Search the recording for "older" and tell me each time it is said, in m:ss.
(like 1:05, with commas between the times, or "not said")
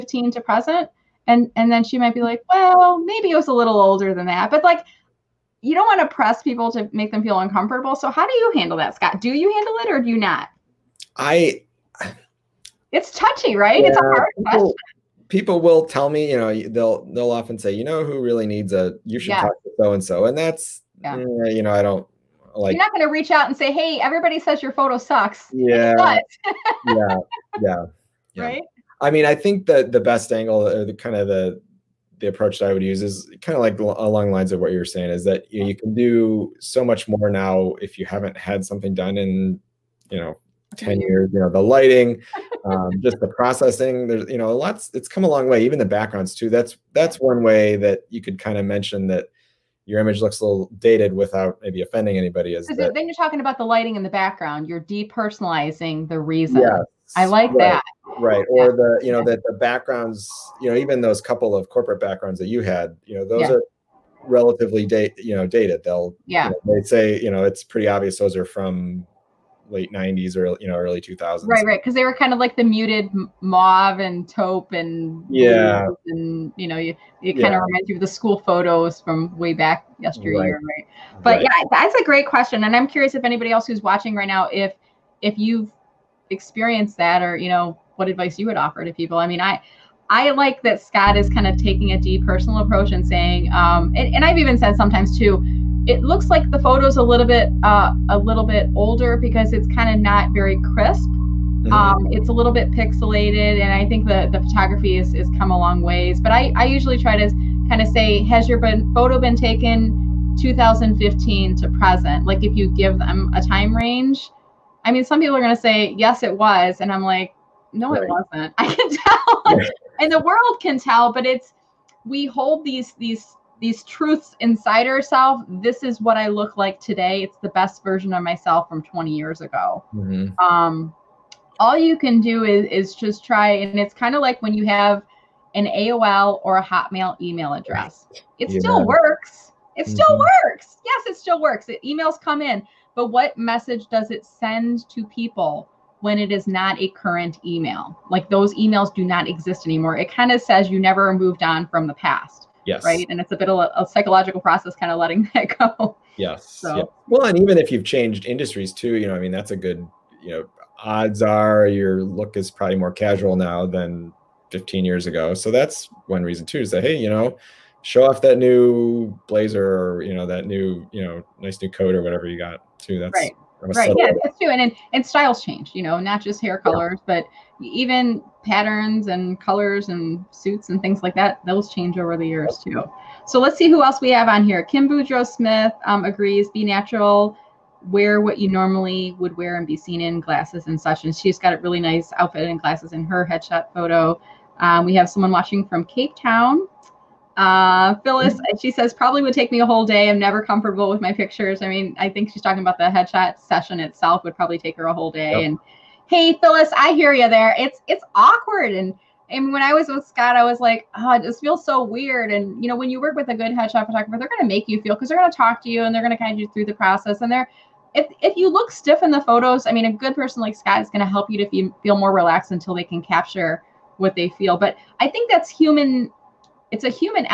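0:03, 1:38.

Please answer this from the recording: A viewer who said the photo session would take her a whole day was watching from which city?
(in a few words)
Cape Town.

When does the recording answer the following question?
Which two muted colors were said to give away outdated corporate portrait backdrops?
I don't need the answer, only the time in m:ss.
1:13.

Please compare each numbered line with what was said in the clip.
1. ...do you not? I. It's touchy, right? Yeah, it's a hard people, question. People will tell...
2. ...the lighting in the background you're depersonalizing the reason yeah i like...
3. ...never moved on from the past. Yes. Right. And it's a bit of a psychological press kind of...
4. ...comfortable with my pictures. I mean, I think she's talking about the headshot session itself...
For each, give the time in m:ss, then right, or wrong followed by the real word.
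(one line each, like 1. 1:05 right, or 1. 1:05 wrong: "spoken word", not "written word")
1. 0:10 right
2. 0:53 right
3. 2:30 wrong: "process", not "press"
4. 3:20 right.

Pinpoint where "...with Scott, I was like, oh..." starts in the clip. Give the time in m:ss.
3:29.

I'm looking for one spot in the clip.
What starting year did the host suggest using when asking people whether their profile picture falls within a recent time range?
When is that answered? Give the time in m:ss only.
1:50.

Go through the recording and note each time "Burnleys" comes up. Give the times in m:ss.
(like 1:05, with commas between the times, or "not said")
not said.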